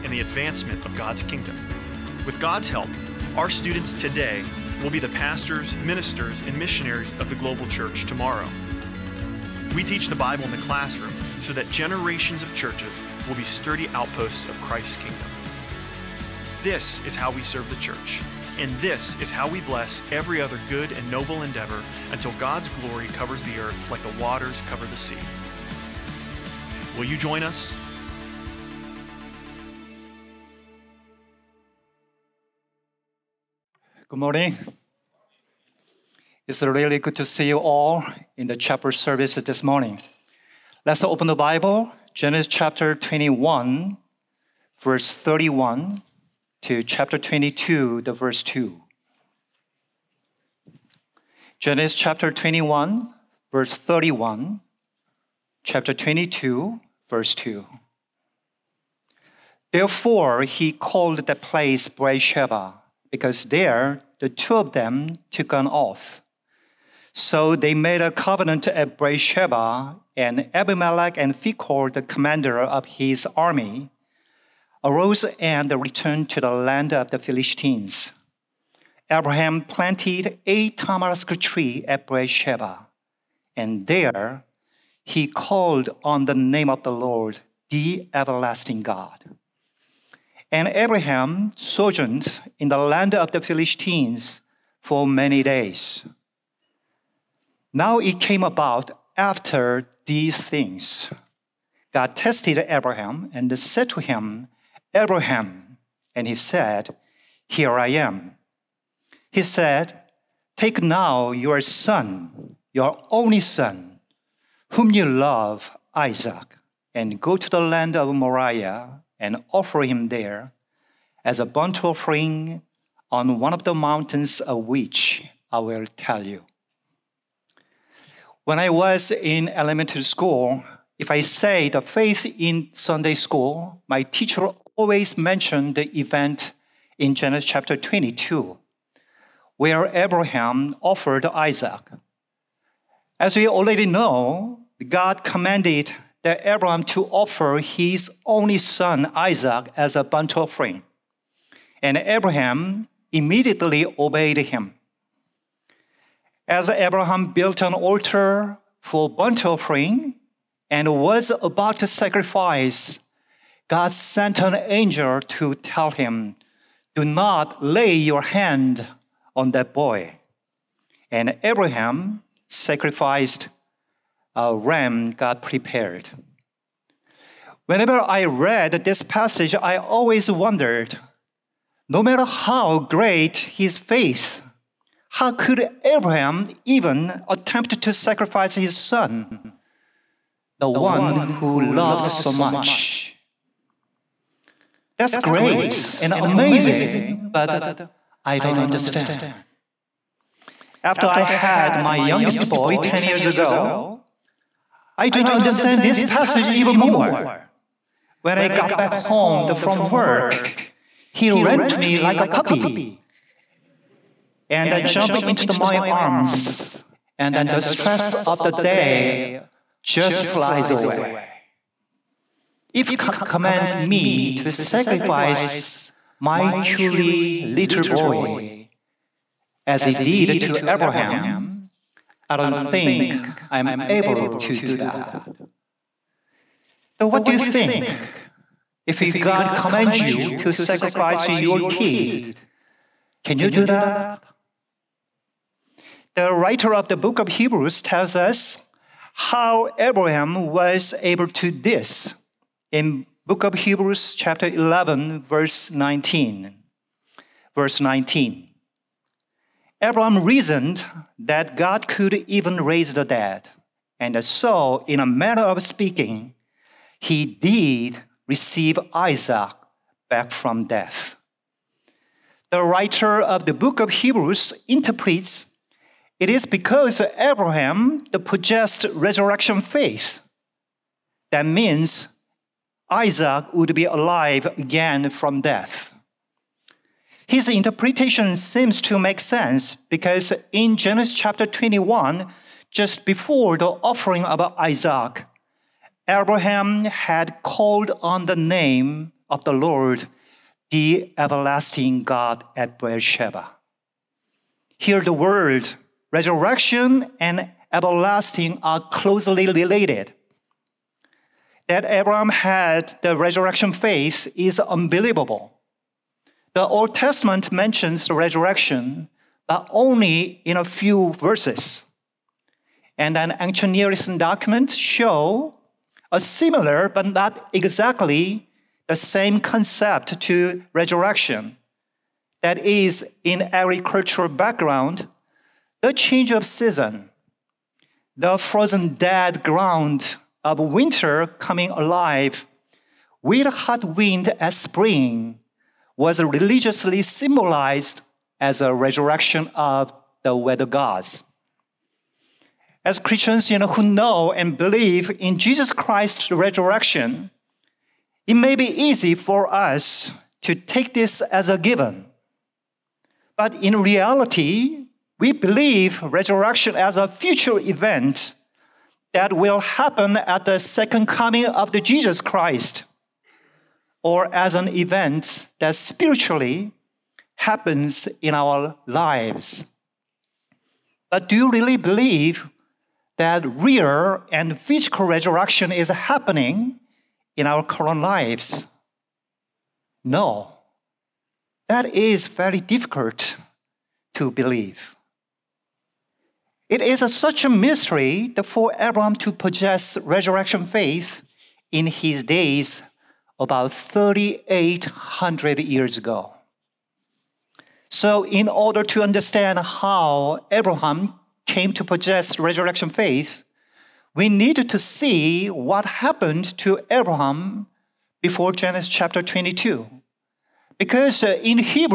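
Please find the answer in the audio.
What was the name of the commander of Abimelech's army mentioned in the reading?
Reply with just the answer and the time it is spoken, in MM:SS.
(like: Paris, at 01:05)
Phicol, at 01:11.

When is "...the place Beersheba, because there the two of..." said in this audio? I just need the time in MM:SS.
01:01.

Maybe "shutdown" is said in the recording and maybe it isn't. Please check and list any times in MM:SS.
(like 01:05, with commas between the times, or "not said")
not said.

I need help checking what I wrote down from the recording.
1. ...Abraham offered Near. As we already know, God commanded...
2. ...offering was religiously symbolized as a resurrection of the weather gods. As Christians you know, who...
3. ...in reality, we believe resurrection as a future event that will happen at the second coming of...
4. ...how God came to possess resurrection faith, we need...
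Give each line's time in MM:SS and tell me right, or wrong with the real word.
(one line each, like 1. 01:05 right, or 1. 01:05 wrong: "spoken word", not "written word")
1. 02:19 wrong: "Isaac", not "Near"
2. 05:44 wrong: "spring", not "offering"
3. 06:03 right
4. 06:49 wrong: "Abraham", not "God".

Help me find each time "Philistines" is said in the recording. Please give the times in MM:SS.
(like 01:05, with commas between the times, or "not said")
01:17, 01:33.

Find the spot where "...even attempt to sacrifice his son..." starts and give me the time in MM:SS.
03:06.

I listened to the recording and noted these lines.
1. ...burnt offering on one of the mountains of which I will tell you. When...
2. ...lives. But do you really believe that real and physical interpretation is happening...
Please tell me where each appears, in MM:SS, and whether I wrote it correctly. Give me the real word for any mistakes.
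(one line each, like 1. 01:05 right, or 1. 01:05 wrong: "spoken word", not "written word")
1. 02:01 right
2. 06:18 wrong: "resurrection", not "interpretation".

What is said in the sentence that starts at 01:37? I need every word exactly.
Now it came about after these things.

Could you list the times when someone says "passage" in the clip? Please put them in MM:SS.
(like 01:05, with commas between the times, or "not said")
02:59, 03:26.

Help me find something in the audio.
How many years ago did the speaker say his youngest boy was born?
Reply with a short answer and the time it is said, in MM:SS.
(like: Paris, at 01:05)
10, at 03:22.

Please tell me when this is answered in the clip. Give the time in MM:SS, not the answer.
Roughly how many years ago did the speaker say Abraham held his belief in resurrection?
06:43.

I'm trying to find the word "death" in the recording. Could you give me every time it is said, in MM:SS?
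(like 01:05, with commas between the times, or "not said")
04:30, 04:45.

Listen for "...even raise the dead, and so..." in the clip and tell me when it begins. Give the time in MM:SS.
04:22.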